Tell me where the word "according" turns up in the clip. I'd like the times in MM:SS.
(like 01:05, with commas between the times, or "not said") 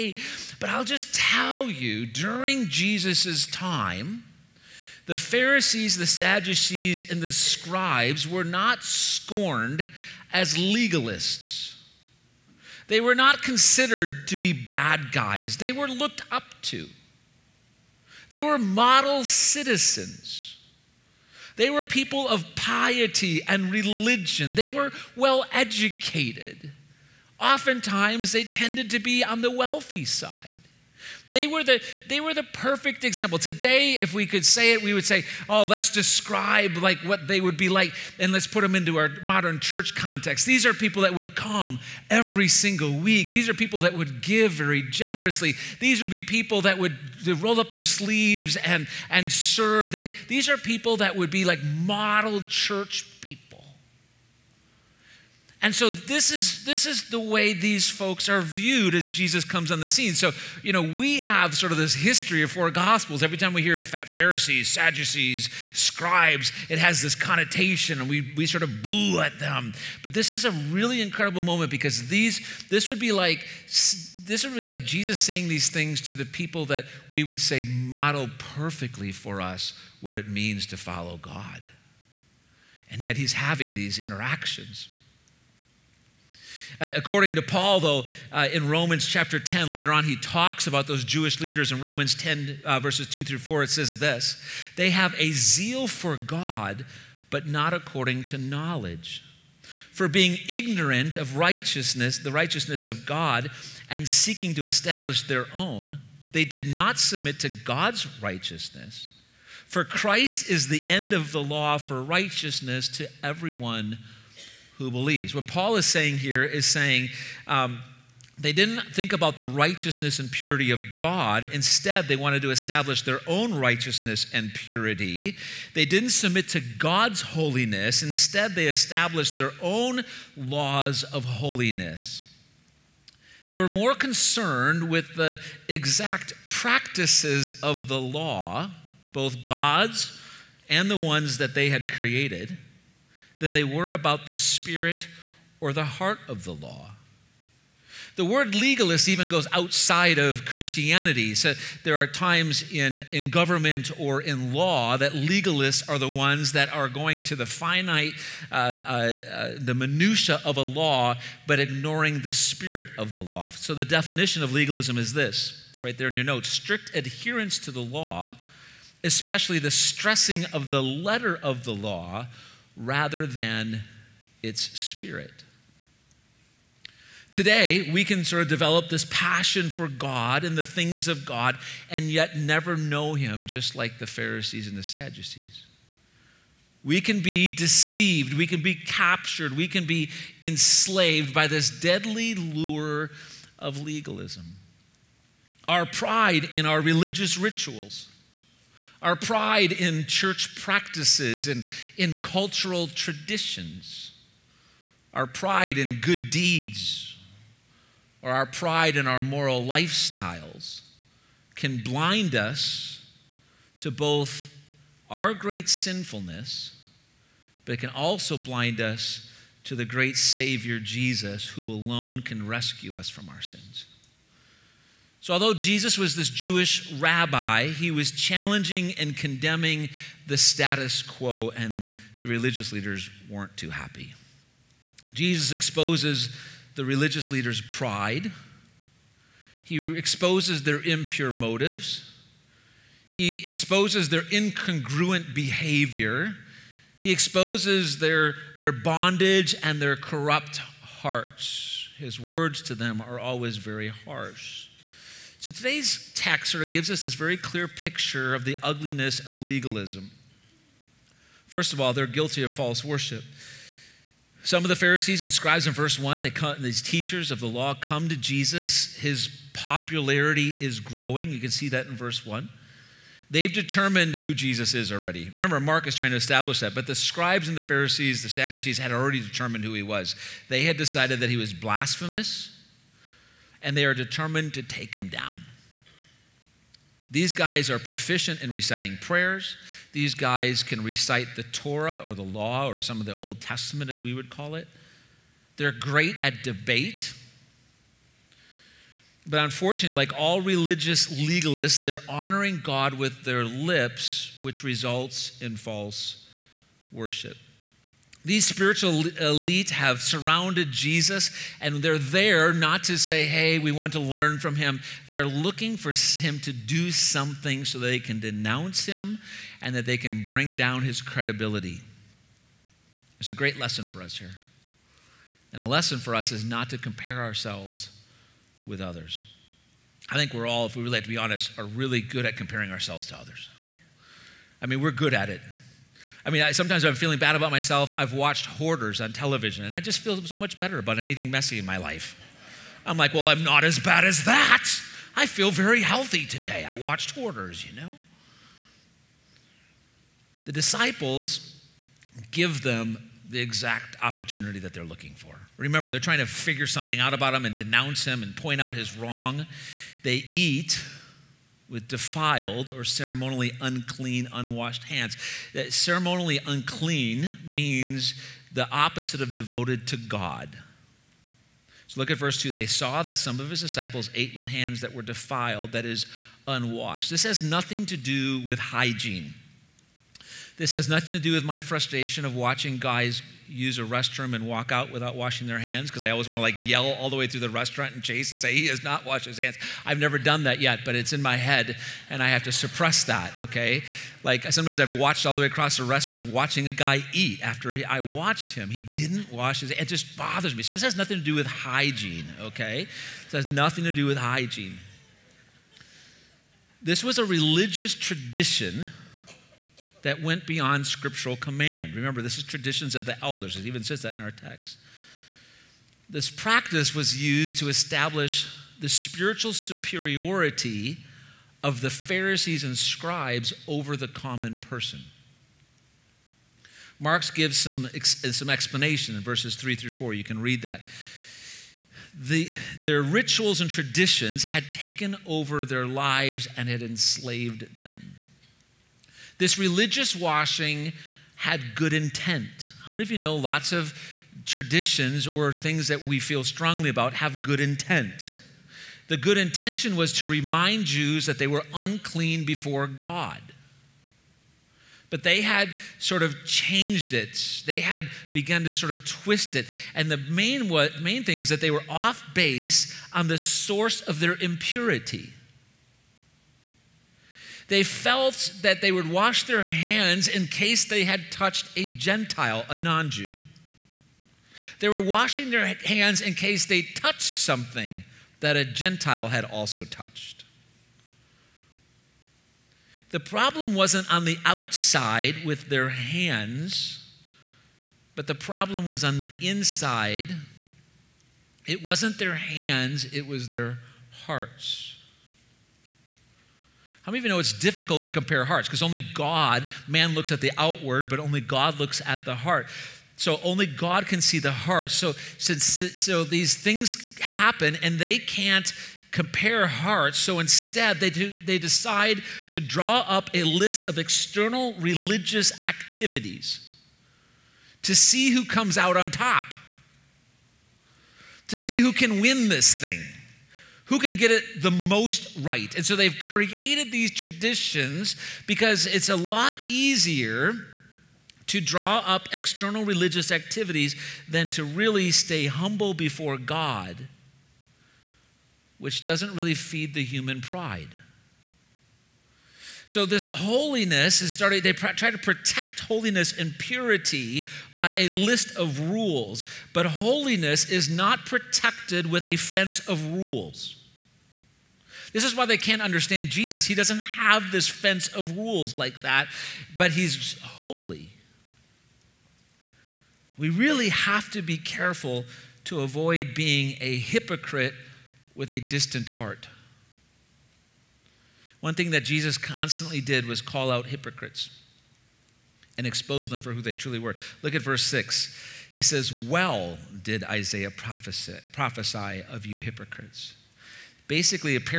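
01:26, 01:37.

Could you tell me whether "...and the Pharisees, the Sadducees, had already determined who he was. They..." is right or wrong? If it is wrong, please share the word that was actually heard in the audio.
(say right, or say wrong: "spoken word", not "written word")
right.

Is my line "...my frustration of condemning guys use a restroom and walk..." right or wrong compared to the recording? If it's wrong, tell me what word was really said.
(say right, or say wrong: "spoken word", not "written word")
wrong: "watching", not "condemning".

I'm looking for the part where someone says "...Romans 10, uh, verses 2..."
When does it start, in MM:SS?
01:31.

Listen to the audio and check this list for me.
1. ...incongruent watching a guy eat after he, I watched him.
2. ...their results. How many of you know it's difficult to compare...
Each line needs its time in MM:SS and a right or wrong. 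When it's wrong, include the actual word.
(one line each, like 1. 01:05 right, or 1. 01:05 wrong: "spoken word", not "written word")
1. 06:35 wrong: "restaurant", not "incongruent"
2. 08:13 wrong: "hearts", not "results".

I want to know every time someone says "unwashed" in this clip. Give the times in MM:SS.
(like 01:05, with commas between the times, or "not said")
06:04, 06:16.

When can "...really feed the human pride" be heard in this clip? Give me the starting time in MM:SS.
08:59.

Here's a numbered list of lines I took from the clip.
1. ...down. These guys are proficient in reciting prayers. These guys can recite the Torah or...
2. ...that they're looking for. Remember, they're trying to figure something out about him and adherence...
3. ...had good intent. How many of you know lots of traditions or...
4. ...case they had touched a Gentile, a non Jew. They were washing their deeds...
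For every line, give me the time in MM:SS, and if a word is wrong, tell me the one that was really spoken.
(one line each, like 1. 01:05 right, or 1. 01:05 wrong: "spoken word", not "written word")
1. 04:45 right
2. 05:54 wrong: "denounce", not "adherence"
3. 07:21 right
4. 07:50 wrong: "hands", not "deeds".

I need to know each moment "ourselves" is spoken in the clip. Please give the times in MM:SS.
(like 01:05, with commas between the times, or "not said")
05:27, 05:32.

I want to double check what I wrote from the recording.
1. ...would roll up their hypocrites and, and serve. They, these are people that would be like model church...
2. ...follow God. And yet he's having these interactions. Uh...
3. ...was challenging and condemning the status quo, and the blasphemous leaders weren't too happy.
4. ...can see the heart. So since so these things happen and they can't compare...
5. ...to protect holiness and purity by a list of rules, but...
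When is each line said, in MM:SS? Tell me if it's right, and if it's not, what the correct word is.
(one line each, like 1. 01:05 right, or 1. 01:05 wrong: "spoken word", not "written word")
1. 00:46 wrong: "sleeves", not "hypocrites"
2. 01:20 right
3. 03:47 wrong: "religious", not "blasphemous"
4. 08:24 right
5. 09:05 right.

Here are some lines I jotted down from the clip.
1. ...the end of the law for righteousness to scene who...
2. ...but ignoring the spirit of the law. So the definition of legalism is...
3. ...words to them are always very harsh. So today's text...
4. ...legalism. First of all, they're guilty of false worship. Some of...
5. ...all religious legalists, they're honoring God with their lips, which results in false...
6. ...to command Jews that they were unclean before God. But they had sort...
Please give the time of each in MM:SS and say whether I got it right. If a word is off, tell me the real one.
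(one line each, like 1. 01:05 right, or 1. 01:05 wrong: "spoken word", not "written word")
1. 01:50 wrong: "everyone", not "scene"
2. 02:41 right
3. 04:12 right
4. 04:19 right
5. 05:00 right
6. 07:30 wrong: "remind", not "command".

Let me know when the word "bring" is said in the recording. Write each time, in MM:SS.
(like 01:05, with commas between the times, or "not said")
05:20.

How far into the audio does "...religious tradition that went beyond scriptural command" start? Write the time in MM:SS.
06:47.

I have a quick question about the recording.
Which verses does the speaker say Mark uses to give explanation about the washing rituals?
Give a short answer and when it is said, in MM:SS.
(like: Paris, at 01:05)
verses 3 through 4, at 07:09.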